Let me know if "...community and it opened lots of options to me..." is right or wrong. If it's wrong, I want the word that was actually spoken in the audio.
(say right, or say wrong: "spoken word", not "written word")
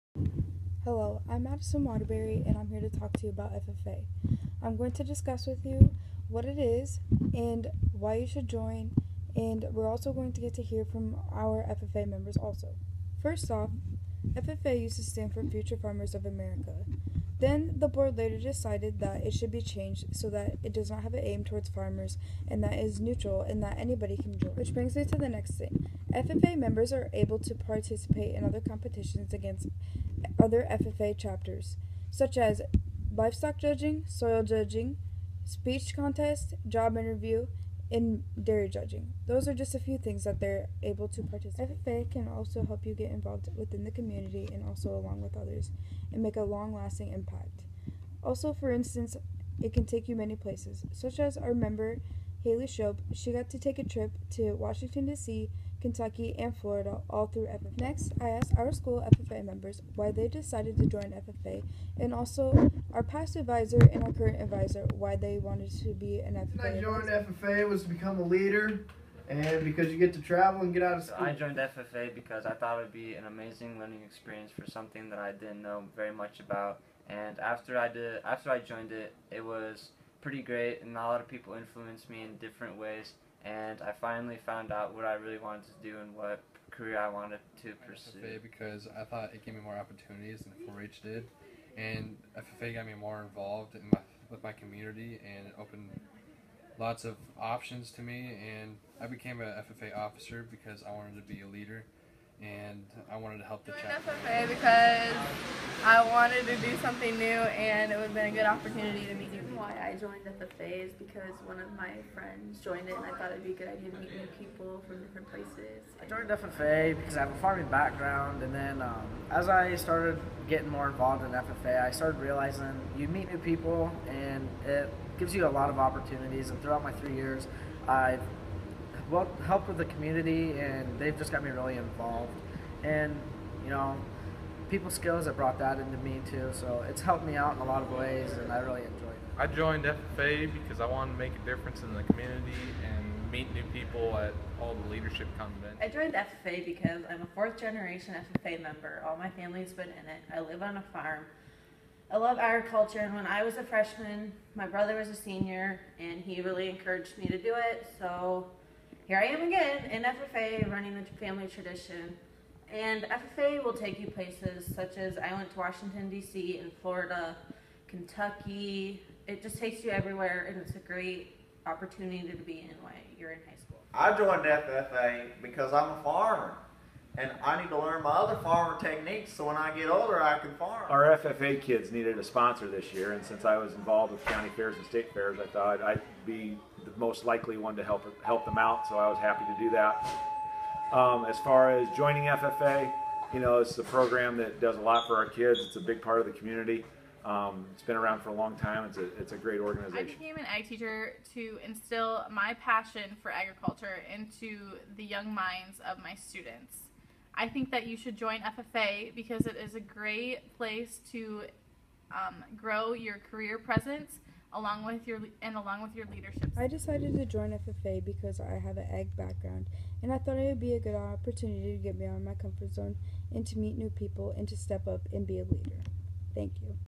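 right.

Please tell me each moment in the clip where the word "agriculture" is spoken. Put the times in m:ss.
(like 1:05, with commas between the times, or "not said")
2:32, 3:23.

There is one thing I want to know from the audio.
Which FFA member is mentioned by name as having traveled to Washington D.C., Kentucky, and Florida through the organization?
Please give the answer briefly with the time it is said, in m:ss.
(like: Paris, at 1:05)
Haley Shope, at 0:52.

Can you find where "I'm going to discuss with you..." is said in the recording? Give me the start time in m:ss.
0:04.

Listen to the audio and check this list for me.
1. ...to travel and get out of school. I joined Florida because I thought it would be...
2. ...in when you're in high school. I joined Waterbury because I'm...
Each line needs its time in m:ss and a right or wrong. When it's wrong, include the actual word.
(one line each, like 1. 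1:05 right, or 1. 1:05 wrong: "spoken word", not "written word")
1. 1:10 wrong: "FFA", not "Florida"
2. 2:52 wrong: "FFA", not "Waterbury".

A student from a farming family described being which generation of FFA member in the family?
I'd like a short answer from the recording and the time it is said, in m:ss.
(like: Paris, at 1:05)
Fourth generation, at 2:27.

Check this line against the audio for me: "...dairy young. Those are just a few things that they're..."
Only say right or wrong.
wrong.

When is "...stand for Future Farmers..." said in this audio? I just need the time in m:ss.
0:15.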